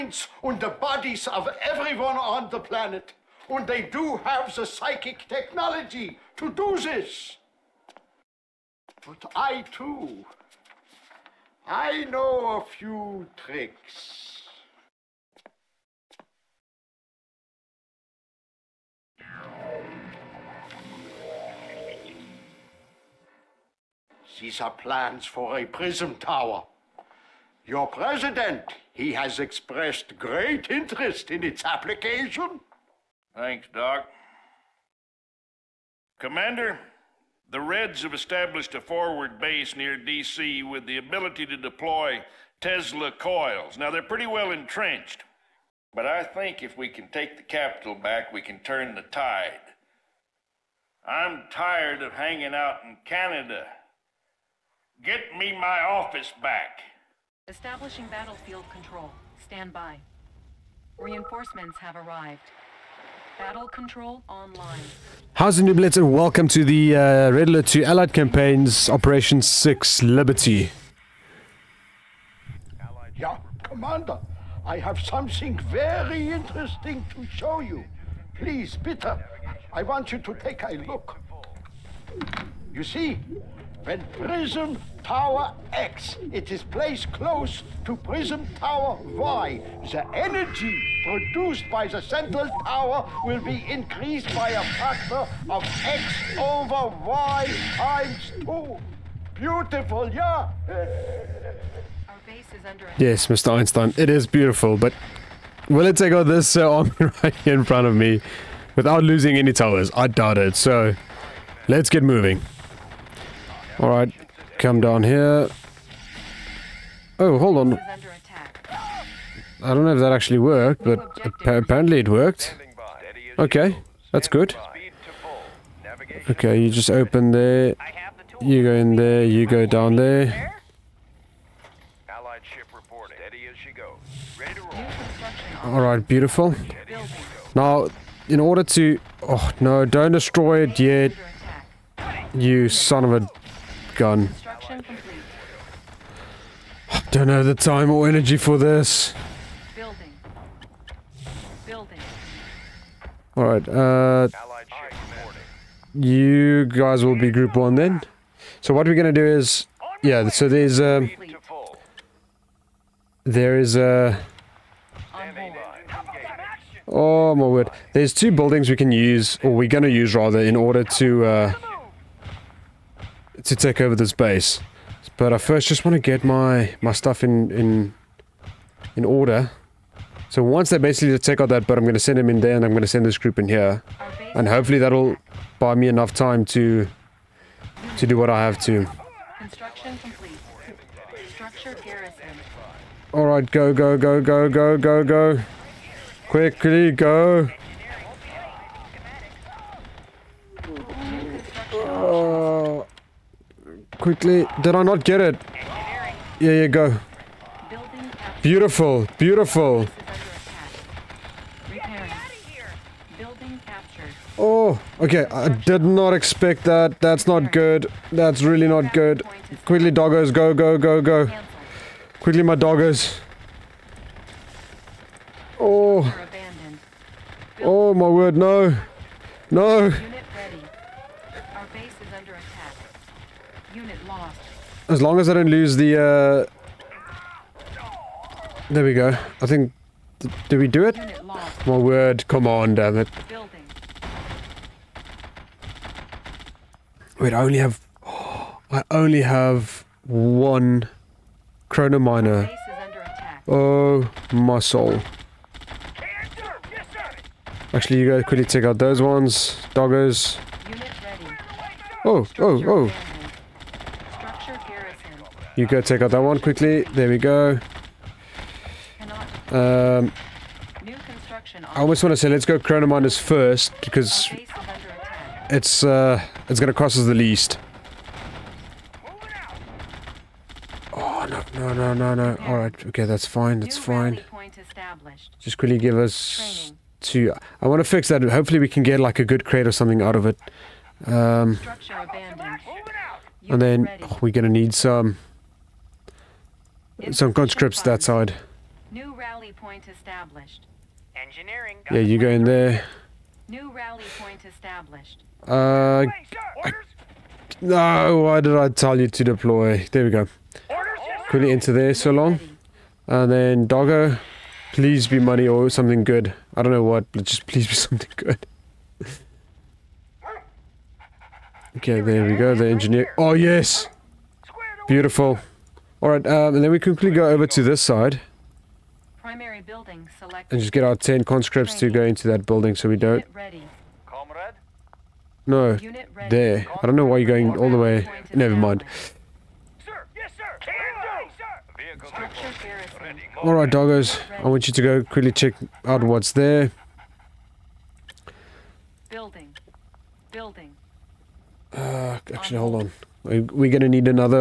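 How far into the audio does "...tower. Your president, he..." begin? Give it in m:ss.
0:26.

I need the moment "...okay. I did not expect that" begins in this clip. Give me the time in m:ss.
3:34.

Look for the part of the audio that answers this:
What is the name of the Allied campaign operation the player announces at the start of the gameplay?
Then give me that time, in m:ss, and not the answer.
1:10.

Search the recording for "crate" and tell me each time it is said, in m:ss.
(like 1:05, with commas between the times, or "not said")
4:49.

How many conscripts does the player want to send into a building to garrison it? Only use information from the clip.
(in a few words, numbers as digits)
10.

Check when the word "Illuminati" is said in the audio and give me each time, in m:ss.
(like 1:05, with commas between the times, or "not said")
not said.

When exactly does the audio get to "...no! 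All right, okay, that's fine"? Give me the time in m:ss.
4:42.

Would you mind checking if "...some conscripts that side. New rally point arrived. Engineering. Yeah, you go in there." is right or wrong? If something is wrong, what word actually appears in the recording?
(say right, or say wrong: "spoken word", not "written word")
wrong: "established", not "arrived".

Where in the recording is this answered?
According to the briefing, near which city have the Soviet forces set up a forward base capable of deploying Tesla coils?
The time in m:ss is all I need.
0:39.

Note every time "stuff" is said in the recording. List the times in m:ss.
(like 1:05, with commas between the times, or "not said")
2:56.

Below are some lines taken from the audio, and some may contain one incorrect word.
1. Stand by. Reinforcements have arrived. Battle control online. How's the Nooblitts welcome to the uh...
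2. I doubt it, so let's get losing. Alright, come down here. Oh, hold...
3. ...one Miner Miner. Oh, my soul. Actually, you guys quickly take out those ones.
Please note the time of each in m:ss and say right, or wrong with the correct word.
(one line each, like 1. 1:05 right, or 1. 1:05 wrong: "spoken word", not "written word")
1. 0:59 right
2. 1:49 wrong: "moving", not "losing"
3. 4:10 wrong: "Chrono", not "Miner".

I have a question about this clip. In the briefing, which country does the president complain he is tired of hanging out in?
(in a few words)
Canada.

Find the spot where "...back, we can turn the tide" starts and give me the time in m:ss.
0:47.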